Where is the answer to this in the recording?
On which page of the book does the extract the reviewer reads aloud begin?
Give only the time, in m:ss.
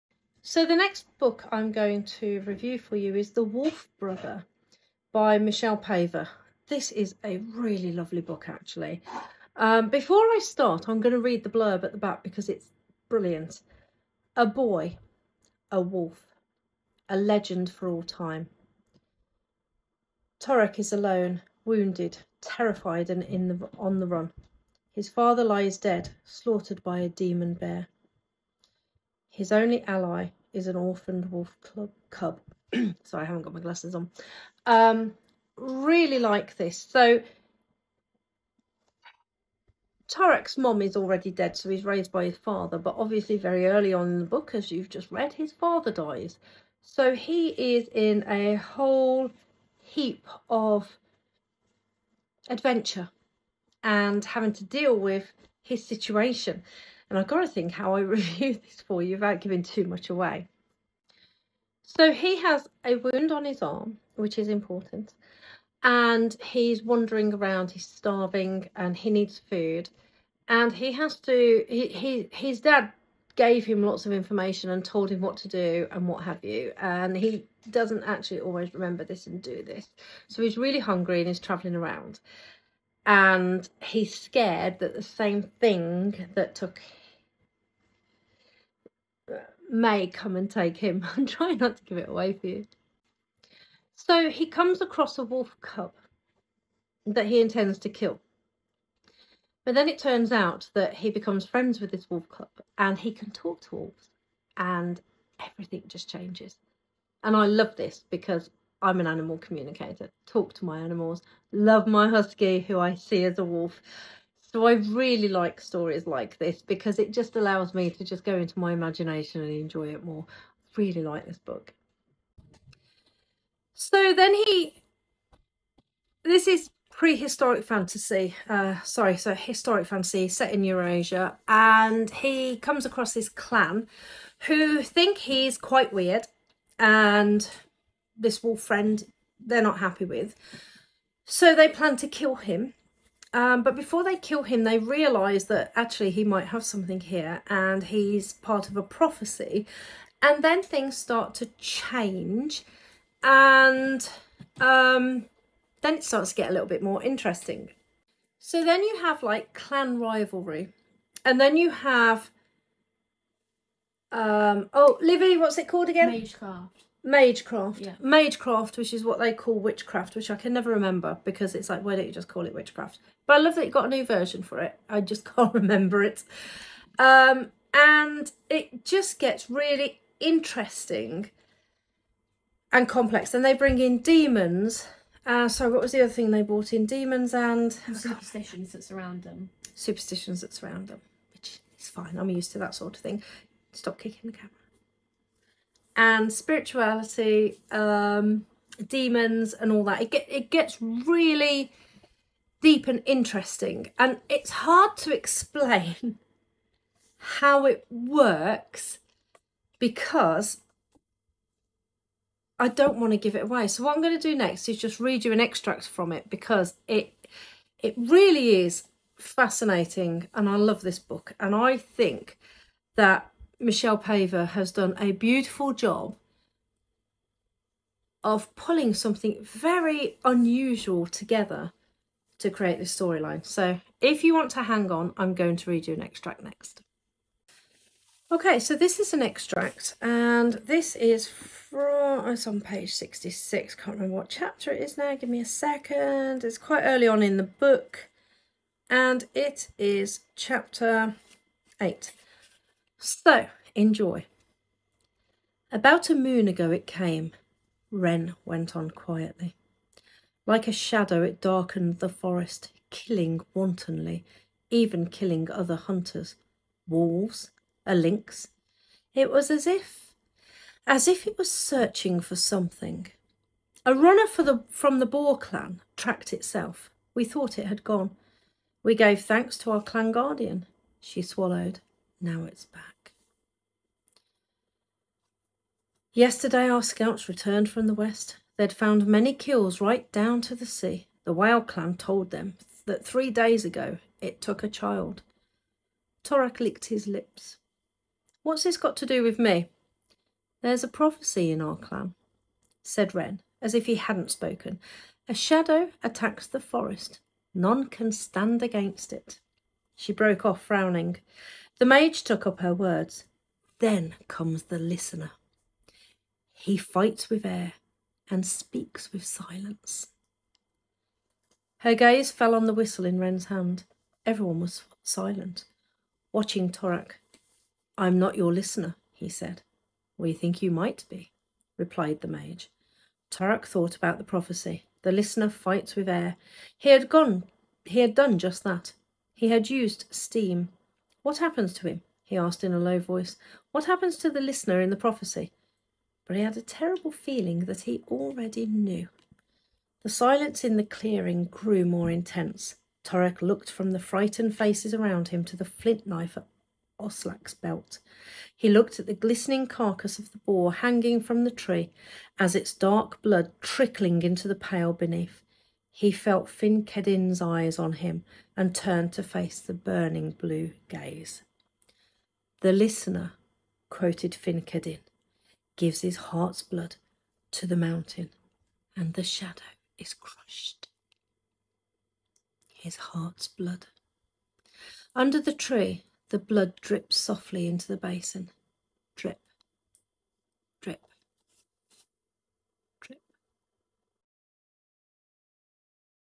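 4:02.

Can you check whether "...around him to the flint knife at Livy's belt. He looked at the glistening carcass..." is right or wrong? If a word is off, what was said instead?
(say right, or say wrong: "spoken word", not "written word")
wrong: "Oslak", not "Livy".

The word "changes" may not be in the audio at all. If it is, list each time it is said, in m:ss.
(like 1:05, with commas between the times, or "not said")
1:46, 2:31.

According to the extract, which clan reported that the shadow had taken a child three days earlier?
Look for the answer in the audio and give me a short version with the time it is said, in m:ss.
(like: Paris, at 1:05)
The whale clan, at 4:51.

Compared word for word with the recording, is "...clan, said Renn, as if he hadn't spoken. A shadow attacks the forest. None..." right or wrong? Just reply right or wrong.
right.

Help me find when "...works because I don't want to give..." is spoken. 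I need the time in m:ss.
3:27.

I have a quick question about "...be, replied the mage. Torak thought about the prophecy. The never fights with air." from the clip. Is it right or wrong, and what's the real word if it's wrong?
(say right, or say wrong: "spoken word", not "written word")
wrong: "listener", not "never".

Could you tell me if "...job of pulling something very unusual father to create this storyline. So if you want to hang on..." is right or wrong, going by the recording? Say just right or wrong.
wrong.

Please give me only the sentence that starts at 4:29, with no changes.
It was as if, as if it was searching for something.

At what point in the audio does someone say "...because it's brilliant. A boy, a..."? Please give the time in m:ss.
0:12.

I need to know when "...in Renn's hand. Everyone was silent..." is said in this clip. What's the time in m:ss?
5:23.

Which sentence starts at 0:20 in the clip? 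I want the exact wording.
Torak is alone, wounded, terrified and in the, on the run.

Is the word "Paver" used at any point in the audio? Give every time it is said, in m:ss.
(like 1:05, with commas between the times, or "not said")
0:05, 3:43.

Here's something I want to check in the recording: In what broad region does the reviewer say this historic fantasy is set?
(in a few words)
Eurasia.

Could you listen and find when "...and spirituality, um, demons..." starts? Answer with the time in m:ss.
3:15.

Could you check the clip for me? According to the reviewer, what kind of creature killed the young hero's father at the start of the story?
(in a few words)
Demon bear.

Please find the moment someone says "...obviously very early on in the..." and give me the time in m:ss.
0:42.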